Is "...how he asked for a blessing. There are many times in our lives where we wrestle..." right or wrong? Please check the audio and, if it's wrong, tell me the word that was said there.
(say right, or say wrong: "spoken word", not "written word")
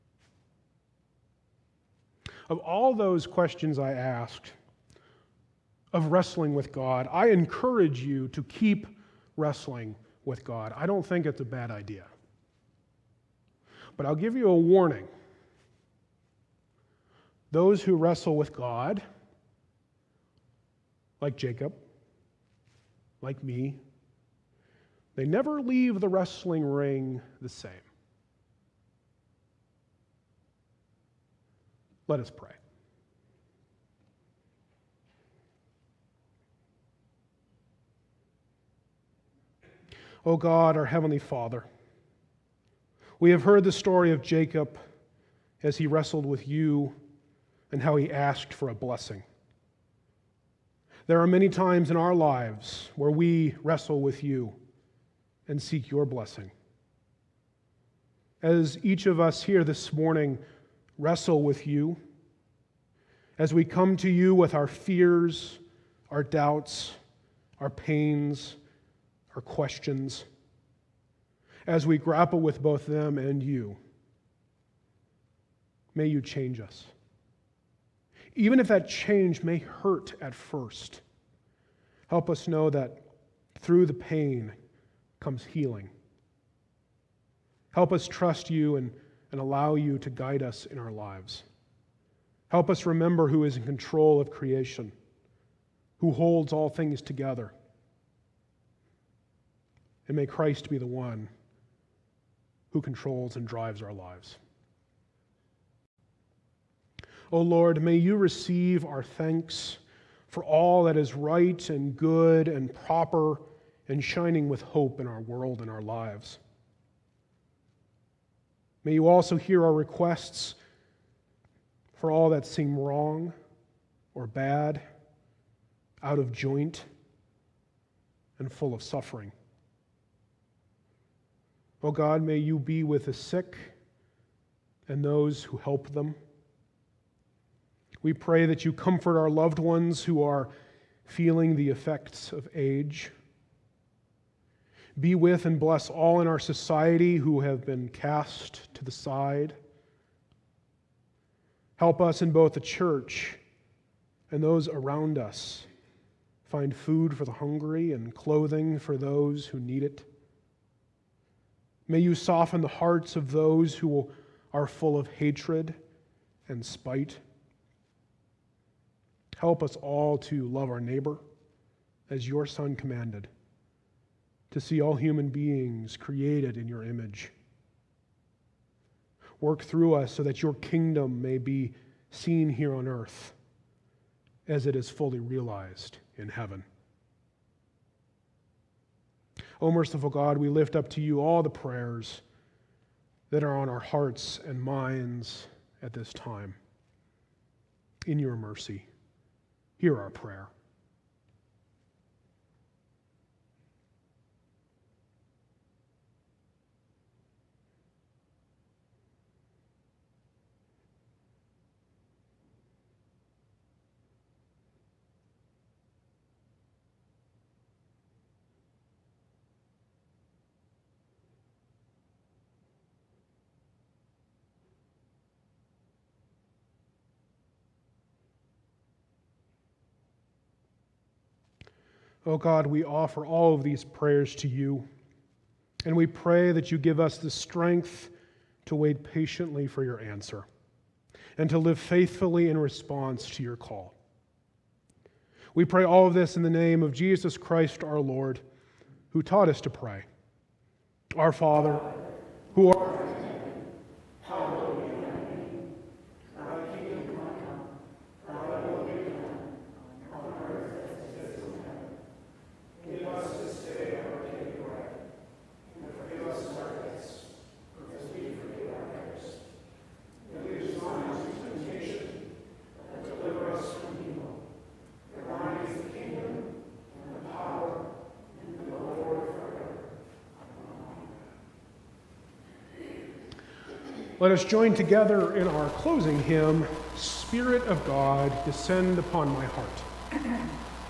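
right.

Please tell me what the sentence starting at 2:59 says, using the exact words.
Work through us so that your kingdom may be seen here on earth as it is fully realized in heaven.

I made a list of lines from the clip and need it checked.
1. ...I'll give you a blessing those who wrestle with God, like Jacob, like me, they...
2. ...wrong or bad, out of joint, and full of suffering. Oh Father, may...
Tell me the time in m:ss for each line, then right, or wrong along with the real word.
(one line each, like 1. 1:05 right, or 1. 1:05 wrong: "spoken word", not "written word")
1. 0:14 wrong: "warning", not "blessing"
2. 2:02 wrong: "God", not "Father".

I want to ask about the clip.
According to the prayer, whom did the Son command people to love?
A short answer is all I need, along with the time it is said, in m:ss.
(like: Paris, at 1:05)
our neighbor, at 2:50.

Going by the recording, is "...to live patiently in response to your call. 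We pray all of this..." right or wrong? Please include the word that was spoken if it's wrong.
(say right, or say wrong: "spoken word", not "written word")
wrong: "faithfully", not "patiently".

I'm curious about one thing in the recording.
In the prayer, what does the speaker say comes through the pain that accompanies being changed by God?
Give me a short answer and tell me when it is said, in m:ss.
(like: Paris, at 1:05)
healing, at 1:25.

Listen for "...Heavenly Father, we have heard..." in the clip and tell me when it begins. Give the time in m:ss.
0:40.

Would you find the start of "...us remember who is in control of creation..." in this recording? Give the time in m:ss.
1:32.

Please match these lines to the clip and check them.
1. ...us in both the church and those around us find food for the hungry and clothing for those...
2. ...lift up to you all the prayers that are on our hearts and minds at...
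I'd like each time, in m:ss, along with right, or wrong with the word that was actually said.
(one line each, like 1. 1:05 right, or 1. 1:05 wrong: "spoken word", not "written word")
1. 2:32 right
2. 3:10 right.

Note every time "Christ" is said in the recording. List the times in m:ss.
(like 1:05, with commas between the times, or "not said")
1:40, 4:07.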